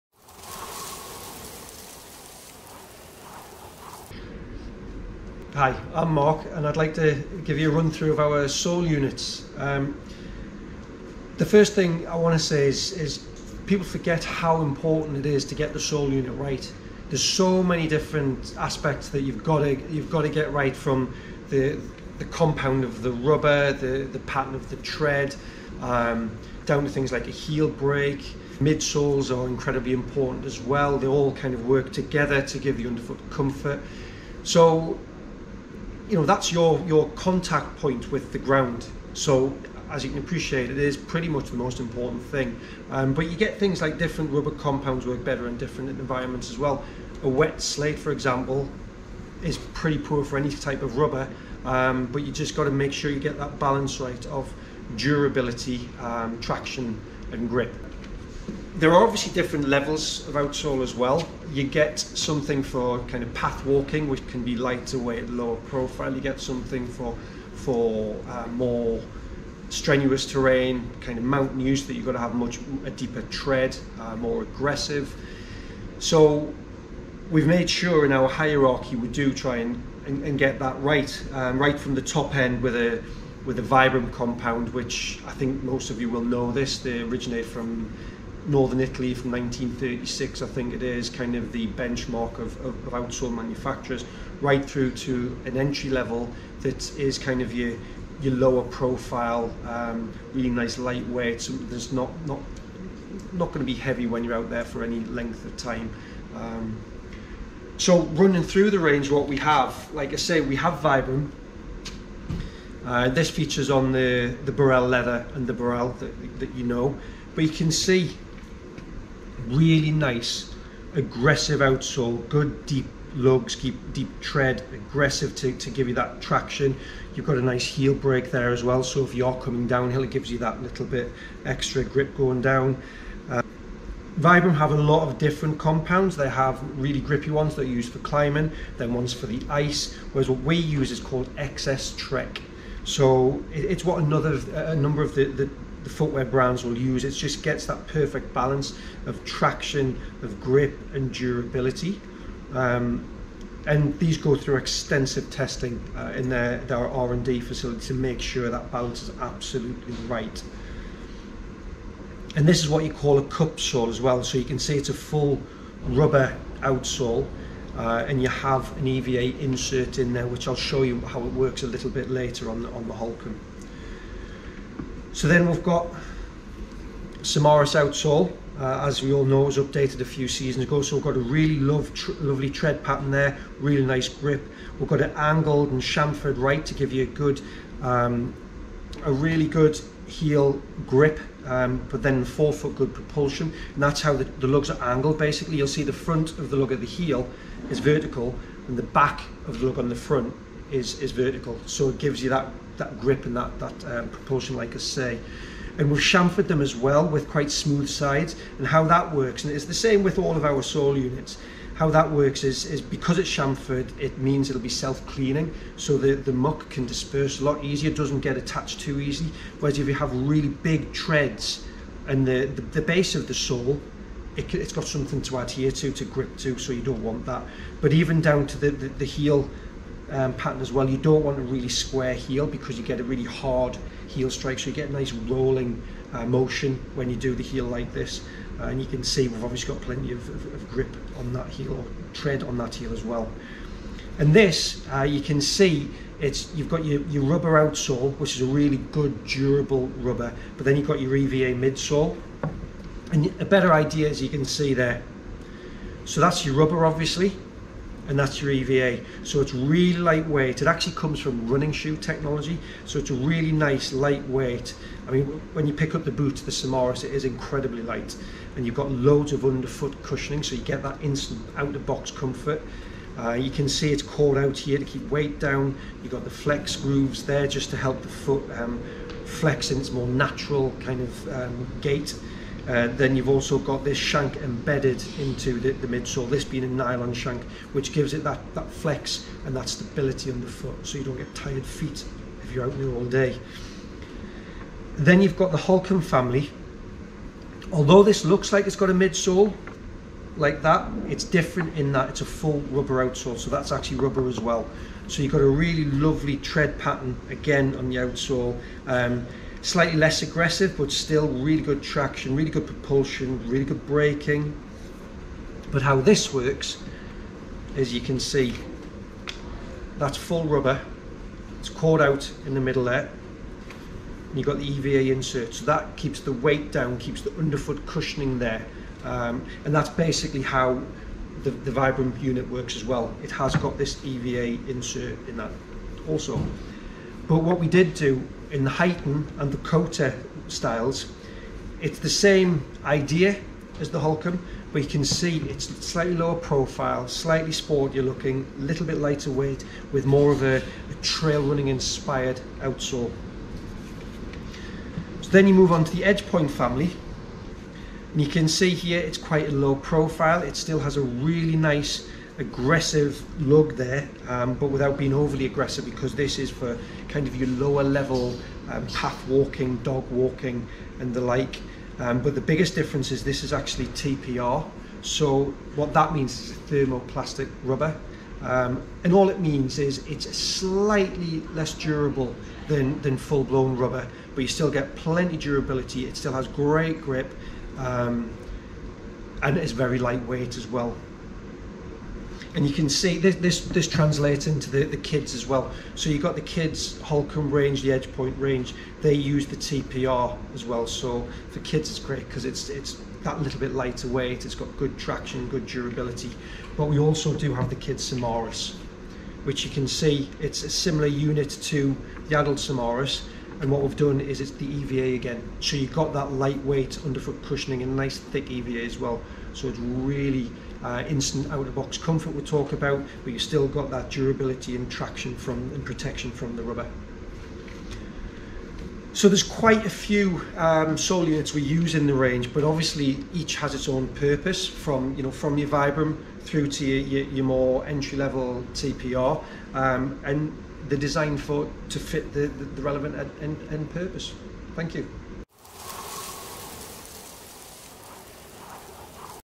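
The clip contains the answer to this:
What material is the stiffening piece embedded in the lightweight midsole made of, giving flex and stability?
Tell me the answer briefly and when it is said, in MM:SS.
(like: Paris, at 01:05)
Nylon, at 04:46.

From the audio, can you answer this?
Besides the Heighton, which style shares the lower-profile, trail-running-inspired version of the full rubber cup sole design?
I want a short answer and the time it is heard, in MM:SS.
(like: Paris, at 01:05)
Kota, at 05:39.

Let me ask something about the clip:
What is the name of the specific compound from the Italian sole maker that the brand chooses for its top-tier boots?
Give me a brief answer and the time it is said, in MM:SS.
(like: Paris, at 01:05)
XS Trek, at 02:21.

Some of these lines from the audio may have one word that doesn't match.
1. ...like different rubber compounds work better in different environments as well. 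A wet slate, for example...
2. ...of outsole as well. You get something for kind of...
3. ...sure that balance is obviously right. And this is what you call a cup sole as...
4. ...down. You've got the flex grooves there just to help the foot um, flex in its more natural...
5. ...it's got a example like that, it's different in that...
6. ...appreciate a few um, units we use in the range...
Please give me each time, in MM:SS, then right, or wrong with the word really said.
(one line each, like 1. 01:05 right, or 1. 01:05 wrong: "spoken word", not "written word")
1. 00:43 right
2. 01:00 right
3. 02:38 wrong: "absolutely", not "obviously"
4. 04:35 right
5. 04:58 wrong: "midsole", not "example"
6. 07:09 wrong: "quite", not "appreciate".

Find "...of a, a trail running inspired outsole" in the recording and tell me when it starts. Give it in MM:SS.
05:50.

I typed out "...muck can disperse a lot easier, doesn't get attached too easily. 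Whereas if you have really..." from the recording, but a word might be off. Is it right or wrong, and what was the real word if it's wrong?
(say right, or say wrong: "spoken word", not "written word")
right.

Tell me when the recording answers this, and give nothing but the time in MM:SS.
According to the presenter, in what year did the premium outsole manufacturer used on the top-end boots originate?
01:29.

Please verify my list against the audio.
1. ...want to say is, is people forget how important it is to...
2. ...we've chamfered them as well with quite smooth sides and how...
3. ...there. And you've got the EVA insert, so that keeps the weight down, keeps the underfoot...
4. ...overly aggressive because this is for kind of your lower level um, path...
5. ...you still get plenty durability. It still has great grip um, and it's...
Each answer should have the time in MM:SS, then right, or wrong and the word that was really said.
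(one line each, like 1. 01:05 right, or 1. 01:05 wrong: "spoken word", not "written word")
1. 00:12 right
2. 03:25 right
3. 05:22 right
4. 06:05 right
5. 06:24 right.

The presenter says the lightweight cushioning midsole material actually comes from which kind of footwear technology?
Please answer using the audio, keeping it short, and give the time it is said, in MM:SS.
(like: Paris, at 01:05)
Running shoe technology, at 04:21.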